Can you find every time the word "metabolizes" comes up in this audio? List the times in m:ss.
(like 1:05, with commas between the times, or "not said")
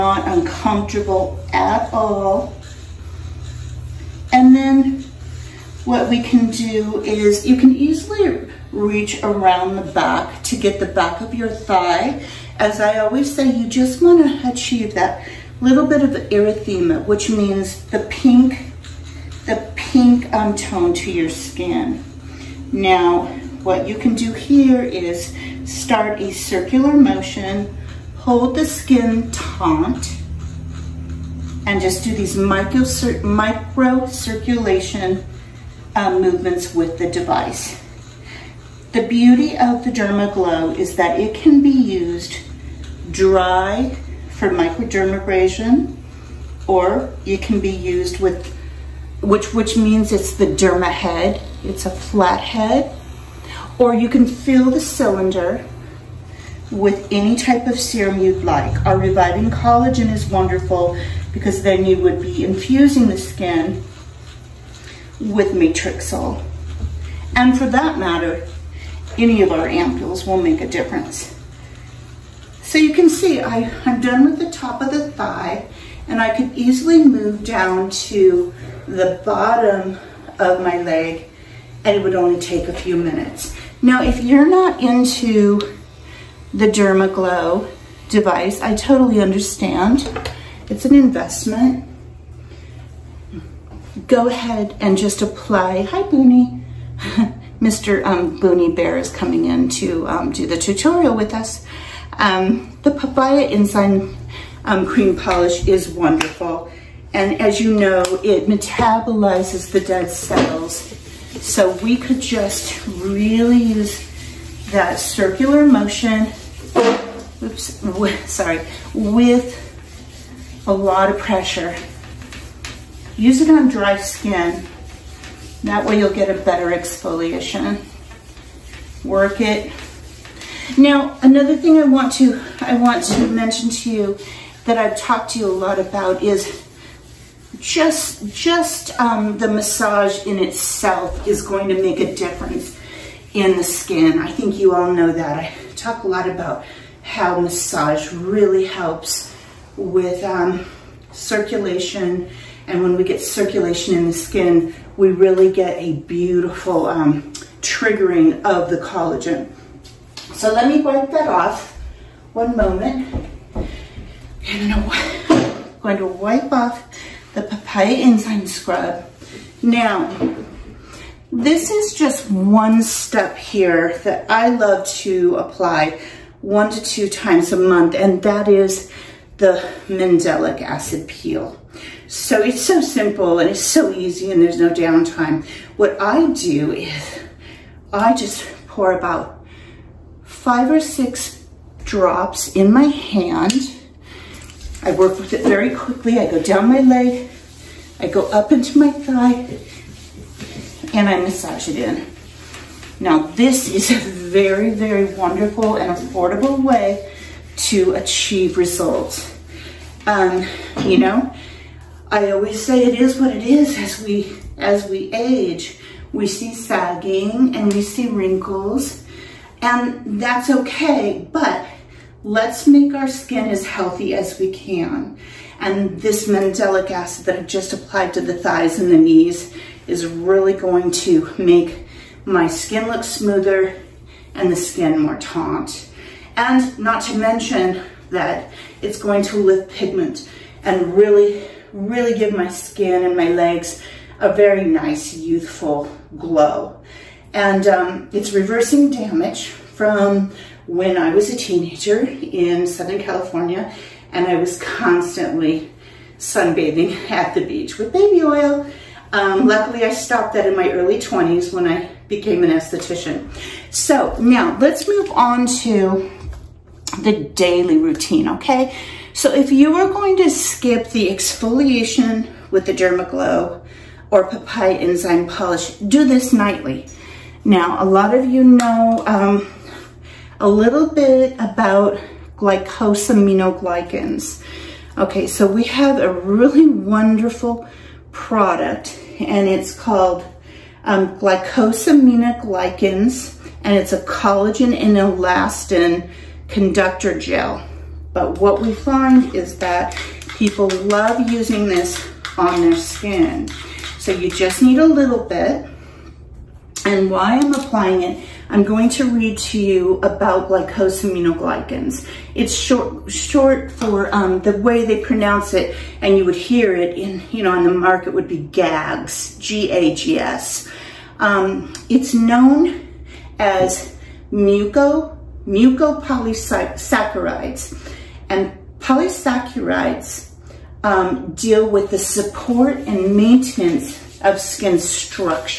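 1:48.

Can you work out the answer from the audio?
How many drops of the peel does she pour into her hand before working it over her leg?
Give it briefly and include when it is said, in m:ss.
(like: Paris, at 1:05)
5 or 6, at 3:10.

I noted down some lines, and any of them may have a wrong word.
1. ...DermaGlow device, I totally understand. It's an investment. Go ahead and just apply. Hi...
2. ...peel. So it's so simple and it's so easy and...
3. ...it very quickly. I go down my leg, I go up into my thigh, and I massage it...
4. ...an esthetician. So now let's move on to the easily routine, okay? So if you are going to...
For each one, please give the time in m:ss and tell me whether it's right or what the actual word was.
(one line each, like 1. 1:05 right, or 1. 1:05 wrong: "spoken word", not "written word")
1. 1:26 right
2. 3:01 right
3. 3:15 right
4. 4:22 wrong: "daily", not "easily".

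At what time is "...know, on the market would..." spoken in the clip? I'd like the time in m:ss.
5:17.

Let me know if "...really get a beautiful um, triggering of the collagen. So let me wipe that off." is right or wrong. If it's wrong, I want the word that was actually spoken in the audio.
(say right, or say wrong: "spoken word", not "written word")
right.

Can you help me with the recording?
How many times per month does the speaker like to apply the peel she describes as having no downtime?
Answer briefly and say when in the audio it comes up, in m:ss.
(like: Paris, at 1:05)
1 to 2, at 2:56.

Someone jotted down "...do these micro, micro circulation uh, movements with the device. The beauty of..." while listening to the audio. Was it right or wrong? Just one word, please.
right.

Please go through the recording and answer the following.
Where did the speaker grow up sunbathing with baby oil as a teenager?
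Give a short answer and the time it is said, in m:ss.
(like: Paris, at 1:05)
Southern California, at 4:12.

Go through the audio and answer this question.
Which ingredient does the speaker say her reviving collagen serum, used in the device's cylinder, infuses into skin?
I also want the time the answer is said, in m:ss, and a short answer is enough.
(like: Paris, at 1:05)
Matrixyl, at 1:05.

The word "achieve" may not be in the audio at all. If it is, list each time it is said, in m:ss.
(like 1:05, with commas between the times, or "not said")
0:14, 3:27.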